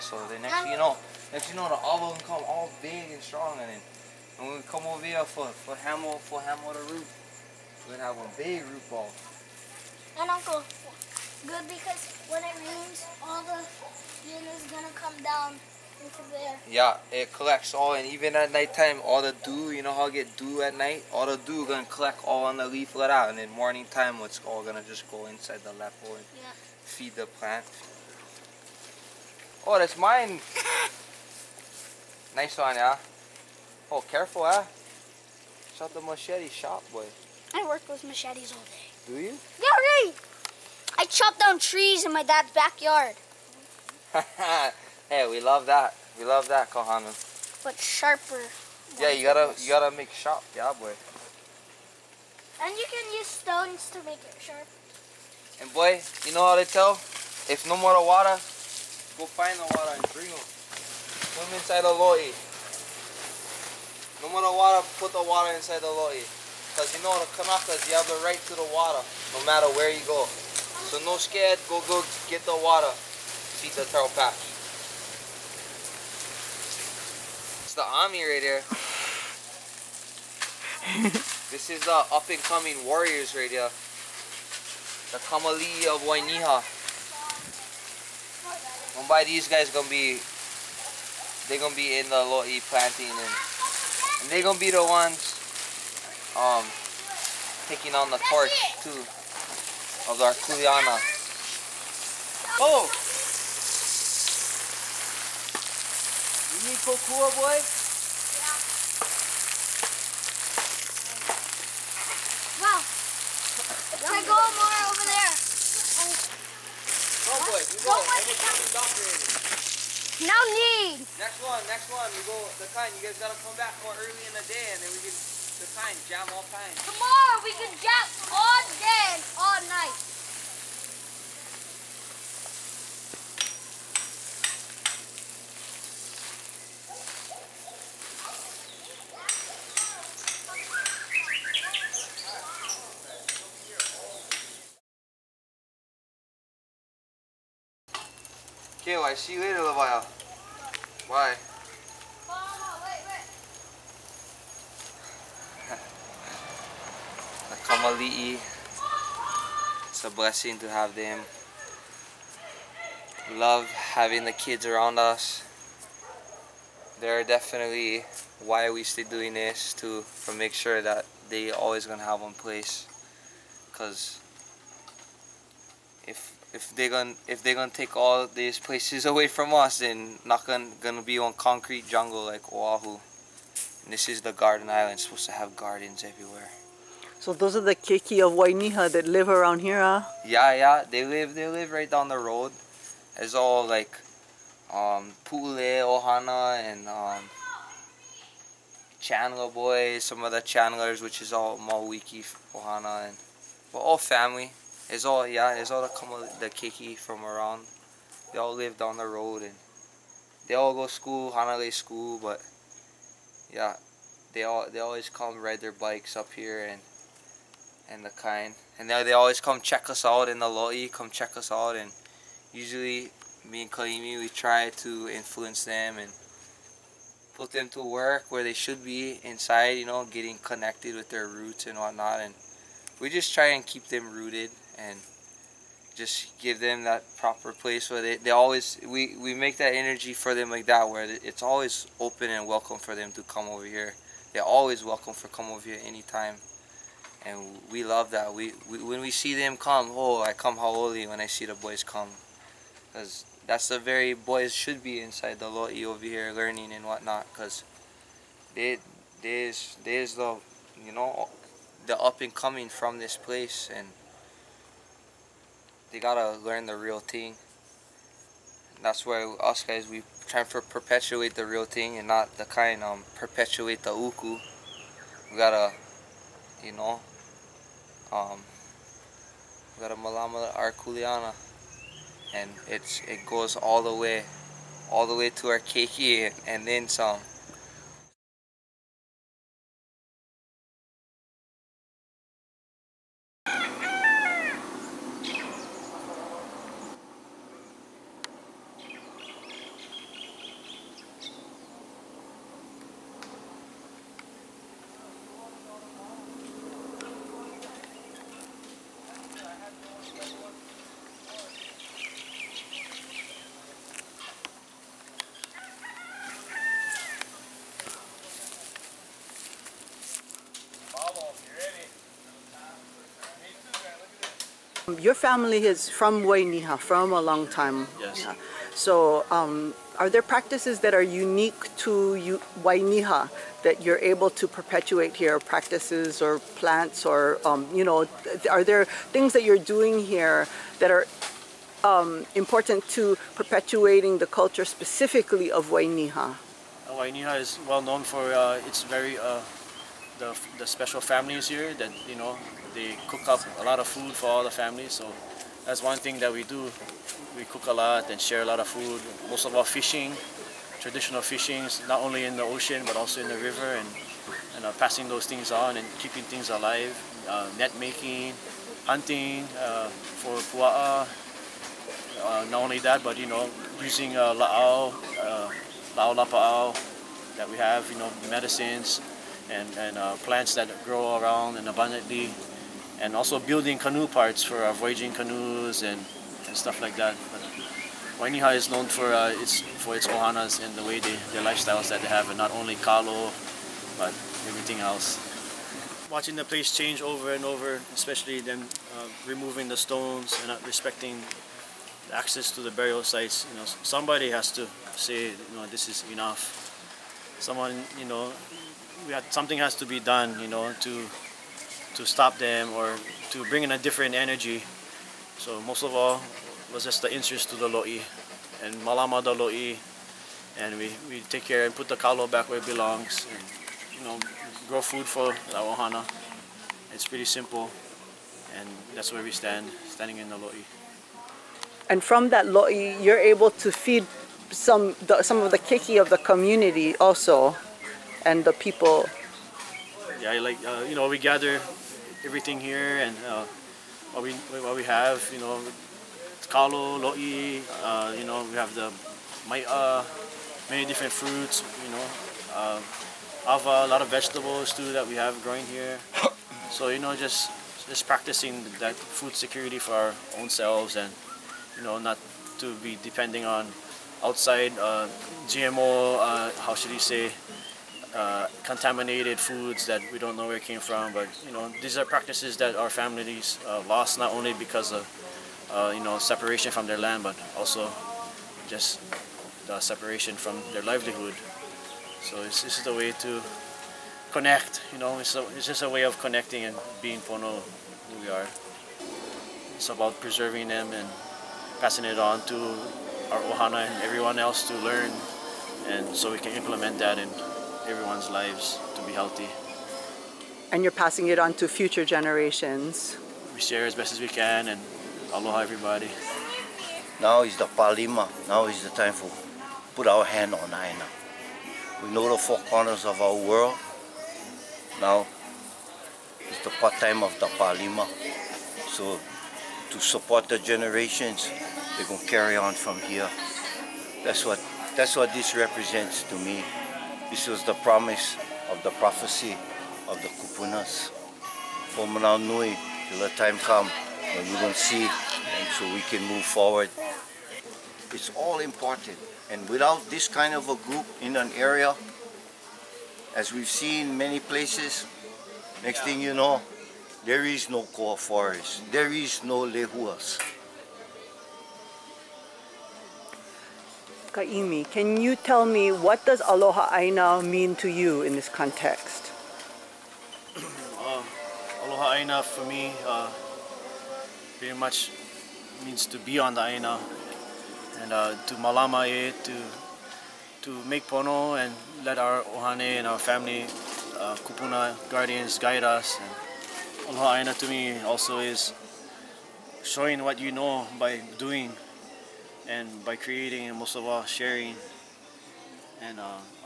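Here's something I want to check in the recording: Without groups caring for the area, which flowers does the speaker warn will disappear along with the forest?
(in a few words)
Lehuas.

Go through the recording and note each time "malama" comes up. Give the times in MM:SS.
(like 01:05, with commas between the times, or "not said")
04:39, 06:58, 09:28.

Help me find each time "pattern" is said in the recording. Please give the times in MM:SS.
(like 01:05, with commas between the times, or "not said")
not said.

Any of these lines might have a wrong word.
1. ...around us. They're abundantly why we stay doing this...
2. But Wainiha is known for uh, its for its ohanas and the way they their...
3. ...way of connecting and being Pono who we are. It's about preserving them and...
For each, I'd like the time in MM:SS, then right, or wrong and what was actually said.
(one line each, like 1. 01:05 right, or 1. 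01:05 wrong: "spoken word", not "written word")
1. 02:44 wrong: "definitely", not "abundantly"
2. 06:27 right
3. 08:05 right.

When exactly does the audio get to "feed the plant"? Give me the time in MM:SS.
00:26.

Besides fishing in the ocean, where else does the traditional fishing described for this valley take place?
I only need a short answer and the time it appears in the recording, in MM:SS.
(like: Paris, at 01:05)
The river, at 06:03.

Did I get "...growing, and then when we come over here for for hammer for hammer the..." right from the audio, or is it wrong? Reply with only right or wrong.
wrong.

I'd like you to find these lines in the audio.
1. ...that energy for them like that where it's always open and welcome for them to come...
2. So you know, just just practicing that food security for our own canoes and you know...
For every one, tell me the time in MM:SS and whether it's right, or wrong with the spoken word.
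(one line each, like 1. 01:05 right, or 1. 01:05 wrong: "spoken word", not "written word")
1. 03:59 right
2. 07:36 wrong: "selves", not "canoes".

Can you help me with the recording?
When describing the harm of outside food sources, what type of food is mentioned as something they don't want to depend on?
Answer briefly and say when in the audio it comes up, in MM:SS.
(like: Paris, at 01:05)
GMO, at 07:45.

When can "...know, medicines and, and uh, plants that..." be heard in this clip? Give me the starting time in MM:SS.
06:17.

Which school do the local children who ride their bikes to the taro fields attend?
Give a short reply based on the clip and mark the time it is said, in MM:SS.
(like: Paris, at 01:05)
Hanalei school, at 03:31.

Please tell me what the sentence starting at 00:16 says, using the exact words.
Yeah, it collects all, and even at nighttime, all the dew, you know how I get dew at night?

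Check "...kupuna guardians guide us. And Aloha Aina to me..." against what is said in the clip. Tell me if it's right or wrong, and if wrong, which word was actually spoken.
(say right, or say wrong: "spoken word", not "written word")
right.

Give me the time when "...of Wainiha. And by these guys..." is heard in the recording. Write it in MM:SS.
01:25.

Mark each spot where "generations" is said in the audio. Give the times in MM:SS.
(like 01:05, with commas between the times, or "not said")
08:22, 08:40.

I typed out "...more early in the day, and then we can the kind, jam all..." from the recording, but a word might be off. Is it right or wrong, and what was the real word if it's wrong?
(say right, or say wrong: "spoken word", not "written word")
right.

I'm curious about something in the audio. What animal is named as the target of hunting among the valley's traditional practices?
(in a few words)
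Pua'a.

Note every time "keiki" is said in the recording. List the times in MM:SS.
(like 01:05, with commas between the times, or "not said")
03:07, 03:26, 04:45, 07:15.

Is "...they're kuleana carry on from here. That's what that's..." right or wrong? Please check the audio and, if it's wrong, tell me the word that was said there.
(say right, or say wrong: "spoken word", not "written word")
wrong: "gonna", not "kuleana".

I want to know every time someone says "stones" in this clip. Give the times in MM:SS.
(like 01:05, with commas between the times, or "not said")
00:53, 06:39.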